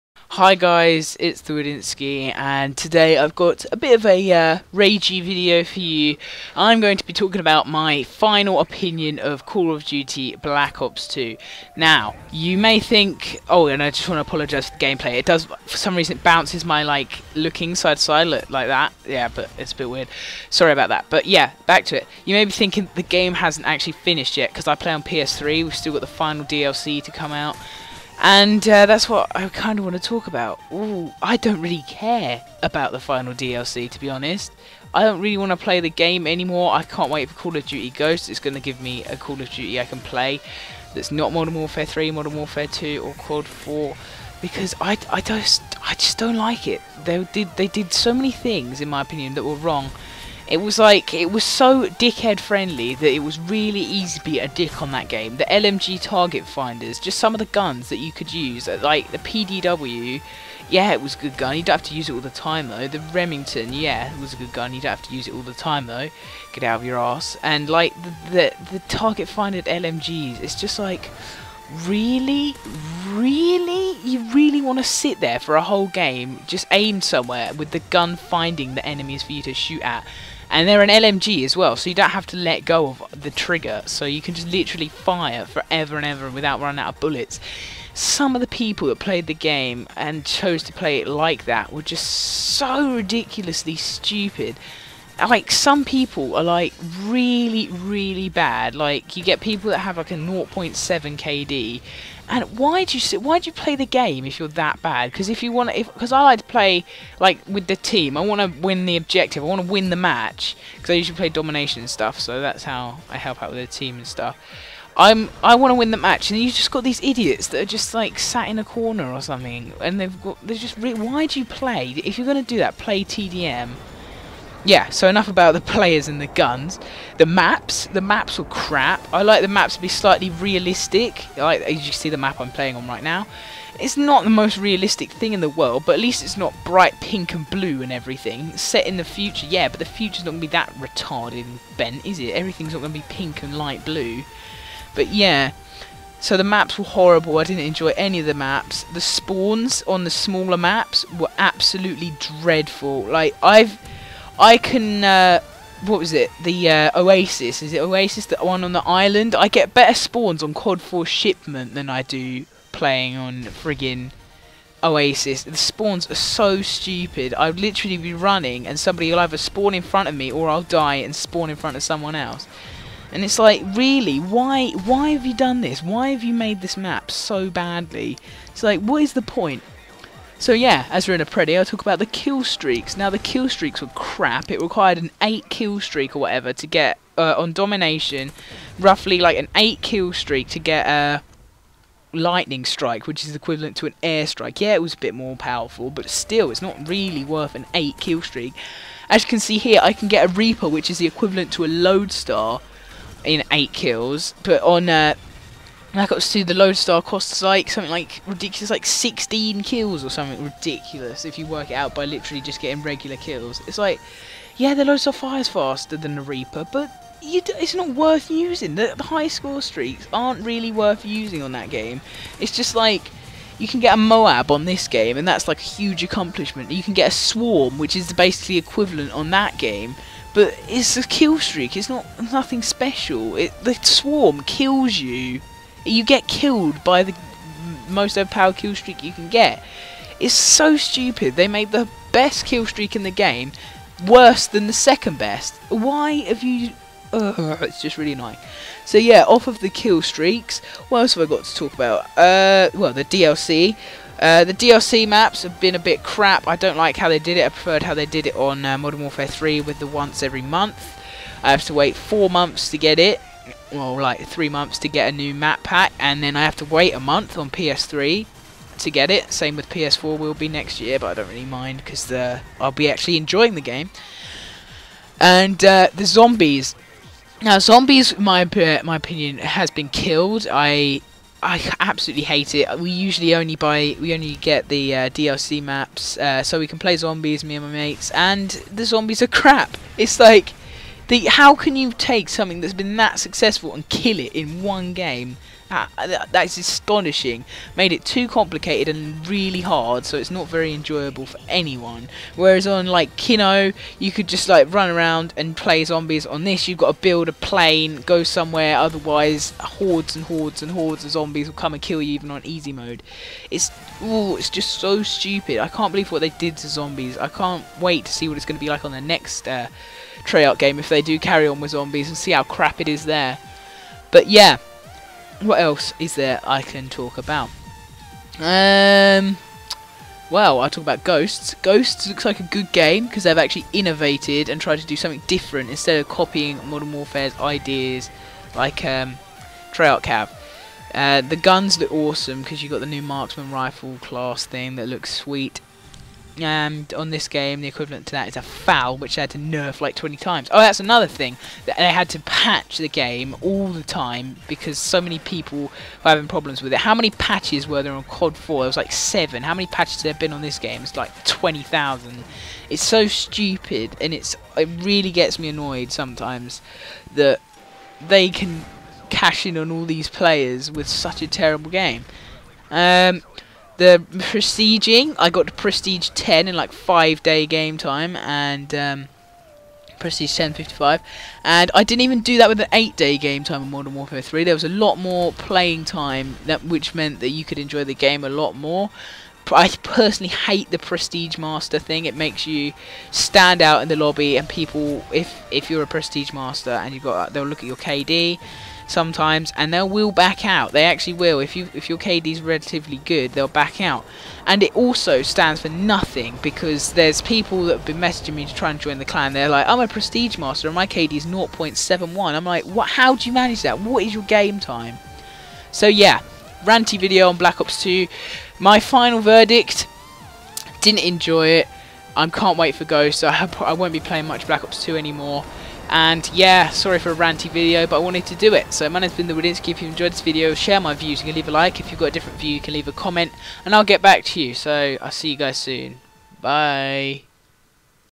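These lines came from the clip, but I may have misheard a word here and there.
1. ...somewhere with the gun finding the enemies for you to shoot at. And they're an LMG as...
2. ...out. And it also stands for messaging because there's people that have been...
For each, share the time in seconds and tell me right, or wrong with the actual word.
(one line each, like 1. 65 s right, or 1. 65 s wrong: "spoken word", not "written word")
1. 76 s right
2. 403 s wrong: "nothing", not "messaging".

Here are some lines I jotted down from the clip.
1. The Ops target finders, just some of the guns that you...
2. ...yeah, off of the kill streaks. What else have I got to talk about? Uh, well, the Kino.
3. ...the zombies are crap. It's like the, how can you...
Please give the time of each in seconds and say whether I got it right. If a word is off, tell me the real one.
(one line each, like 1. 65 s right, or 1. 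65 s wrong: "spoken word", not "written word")
1. 55 s wrong: "LMG", not "Ops"
2. 248 s wrong: "DLC", not "Kino"
3. 288 s right.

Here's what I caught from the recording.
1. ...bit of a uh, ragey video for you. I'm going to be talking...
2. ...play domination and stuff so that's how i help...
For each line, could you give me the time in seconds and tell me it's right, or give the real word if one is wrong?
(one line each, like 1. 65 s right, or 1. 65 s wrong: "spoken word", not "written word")
1. 3 s right
2. 111 s right.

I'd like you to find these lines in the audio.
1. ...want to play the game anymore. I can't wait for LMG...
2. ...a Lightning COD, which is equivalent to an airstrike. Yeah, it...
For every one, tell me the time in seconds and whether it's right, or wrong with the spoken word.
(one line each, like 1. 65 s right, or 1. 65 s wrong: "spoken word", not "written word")
1. 35 s wrong: "Call", not "LMG"
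2. 190 s wrong: "Strike", not "COD".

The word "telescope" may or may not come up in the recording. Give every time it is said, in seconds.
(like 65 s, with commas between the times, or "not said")
not said.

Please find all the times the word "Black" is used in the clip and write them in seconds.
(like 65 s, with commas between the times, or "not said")
10 s, 417 s, 424 s.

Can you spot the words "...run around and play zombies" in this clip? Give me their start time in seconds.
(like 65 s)
304 s.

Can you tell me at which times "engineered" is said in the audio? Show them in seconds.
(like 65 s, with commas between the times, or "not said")
not said.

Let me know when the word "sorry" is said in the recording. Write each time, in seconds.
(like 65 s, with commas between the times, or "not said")
20 s, 426 s.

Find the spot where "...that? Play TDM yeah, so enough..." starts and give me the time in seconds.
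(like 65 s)
122 s.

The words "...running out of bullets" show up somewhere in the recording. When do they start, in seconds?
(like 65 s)
86 s.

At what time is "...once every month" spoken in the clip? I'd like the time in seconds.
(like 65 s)
259 s.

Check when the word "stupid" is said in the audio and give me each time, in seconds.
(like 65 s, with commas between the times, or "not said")
93 s, 166 s, 240 s, 315 s, 363 s.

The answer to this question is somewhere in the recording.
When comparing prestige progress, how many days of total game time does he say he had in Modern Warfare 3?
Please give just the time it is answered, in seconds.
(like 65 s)
382 s.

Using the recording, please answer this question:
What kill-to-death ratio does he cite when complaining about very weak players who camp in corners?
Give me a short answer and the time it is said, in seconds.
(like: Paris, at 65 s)
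0.7, at 100 s.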